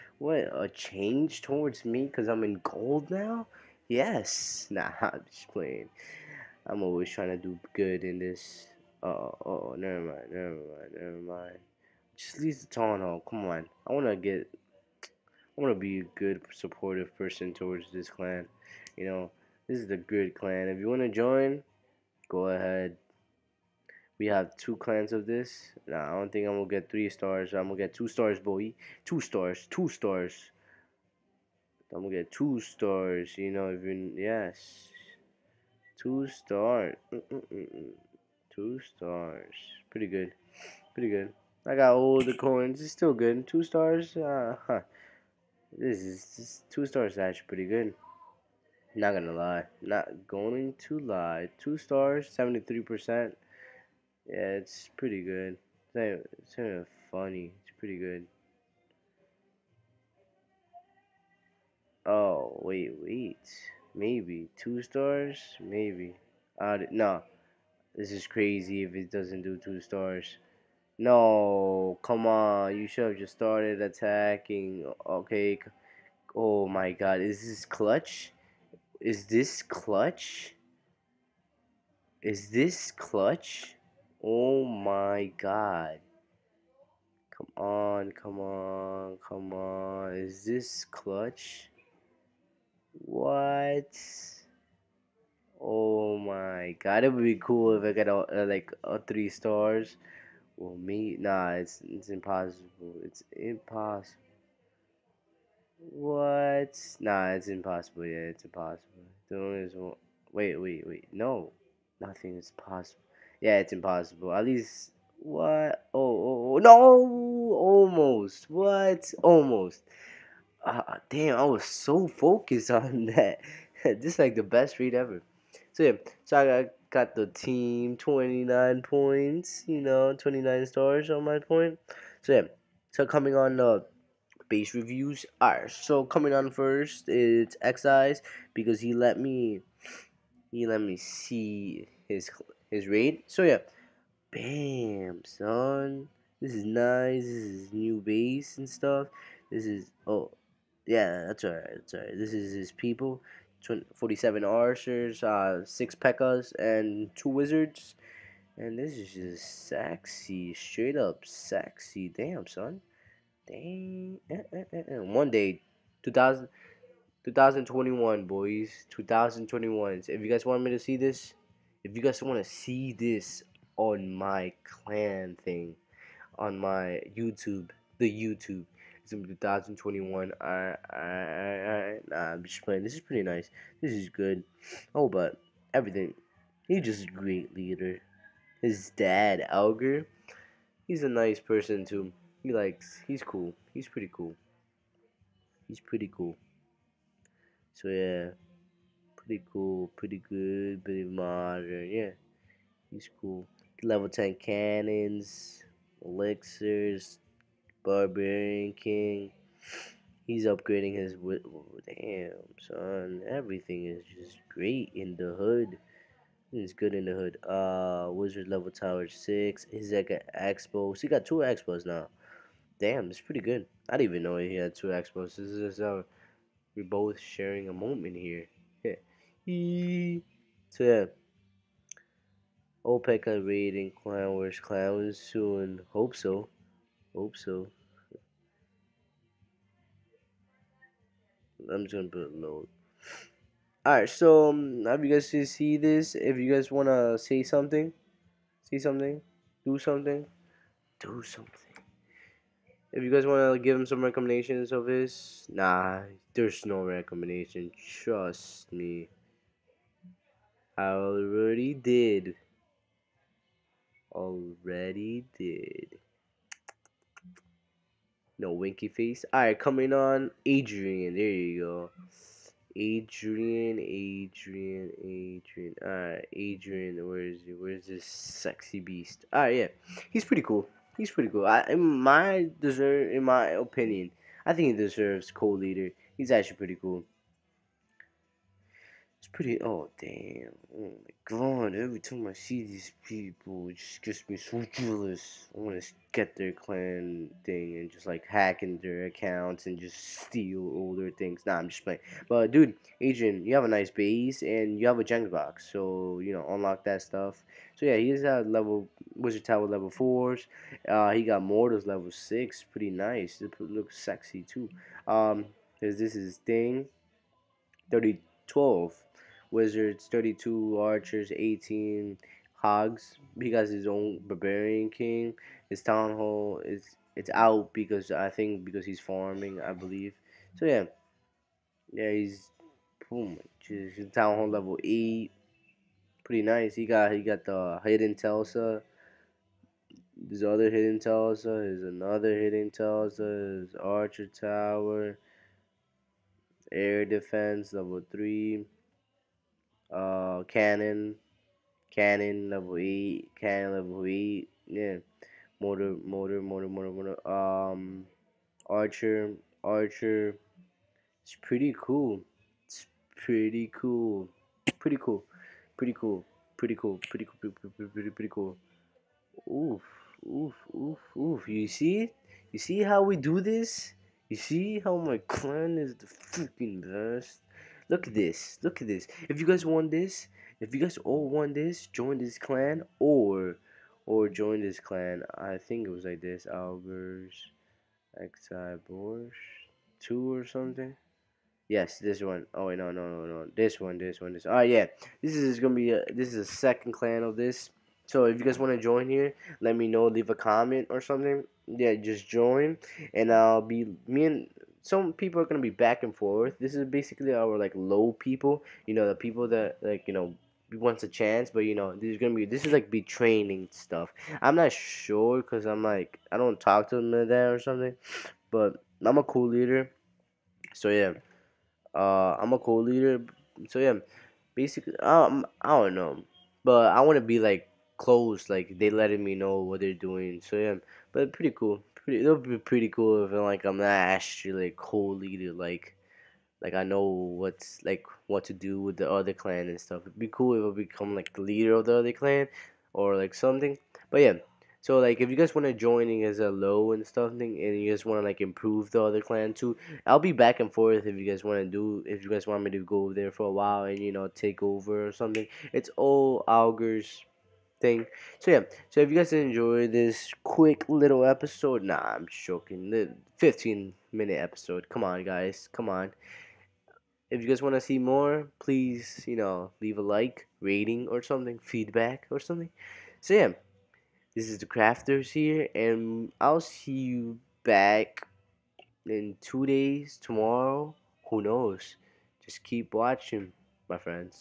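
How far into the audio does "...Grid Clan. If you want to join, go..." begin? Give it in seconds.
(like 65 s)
19 s.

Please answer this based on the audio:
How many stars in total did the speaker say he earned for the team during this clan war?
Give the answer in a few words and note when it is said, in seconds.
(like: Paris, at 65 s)
29, at 130 s.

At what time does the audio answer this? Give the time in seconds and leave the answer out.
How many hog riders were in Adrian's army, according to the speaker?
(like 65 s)
321 s.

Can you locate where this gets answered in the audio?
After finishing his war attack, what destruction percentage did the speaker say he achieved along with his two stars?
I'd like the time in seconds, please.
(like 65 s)
52 s.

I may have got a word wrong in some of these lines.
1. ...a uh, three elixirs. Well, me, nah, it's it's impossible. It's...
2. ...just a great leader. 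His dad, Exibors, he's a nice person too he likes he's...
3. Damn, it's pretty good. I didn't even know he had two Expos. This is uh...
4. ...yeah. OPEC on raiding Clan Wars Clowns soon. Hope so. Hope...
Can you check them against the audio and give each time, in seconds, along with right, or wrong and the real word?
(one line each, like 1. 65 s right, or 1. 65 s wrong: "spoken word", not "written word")
1. 98 s wrong: "stars", not "elixirs"
2. 186 s wrong: "Alger", not "Exibors"
3. 222 s right
4. 230 s right.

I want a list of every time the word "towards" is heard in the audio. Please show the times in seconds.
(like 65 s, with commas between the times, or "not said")
1 s, 17 s.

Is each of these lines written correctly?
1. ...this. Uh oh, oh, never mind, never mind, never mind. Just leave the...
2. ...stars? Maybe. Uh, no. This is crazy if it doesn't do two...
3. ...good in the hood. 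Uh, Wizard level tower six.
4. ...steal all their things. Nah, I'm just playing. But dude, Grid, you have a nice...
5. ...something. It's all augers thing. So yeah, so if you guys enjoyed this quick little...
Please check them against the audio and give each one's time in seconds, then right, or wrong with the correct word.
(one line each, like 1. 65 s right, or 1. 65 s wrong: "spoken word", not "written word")
1. 8 s right
2. 64 s right
3. 216 s right
4. 300 s wrong: "Adrian", not "Grid"
5. 455 s right.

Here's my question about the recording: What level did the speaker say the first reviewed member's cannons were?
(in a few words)
10.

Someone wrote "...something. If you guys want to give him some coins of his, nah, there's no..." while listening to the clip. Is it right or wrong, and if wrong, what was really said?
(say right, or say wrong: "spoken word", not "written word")
wrong: "recommendations", not "coins".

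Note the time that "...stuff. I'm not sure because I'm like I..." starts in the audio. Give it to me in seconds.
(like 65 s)
413 s.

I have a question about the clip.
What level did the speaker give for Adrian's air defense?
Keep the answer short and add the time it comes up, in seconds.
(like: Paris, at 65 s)
3, at 346 s.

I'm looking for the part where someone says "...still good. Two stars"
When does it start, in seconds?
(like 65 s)
42 s.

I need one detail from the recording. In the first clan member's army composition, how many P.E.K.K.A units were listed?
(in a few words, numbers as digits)
6.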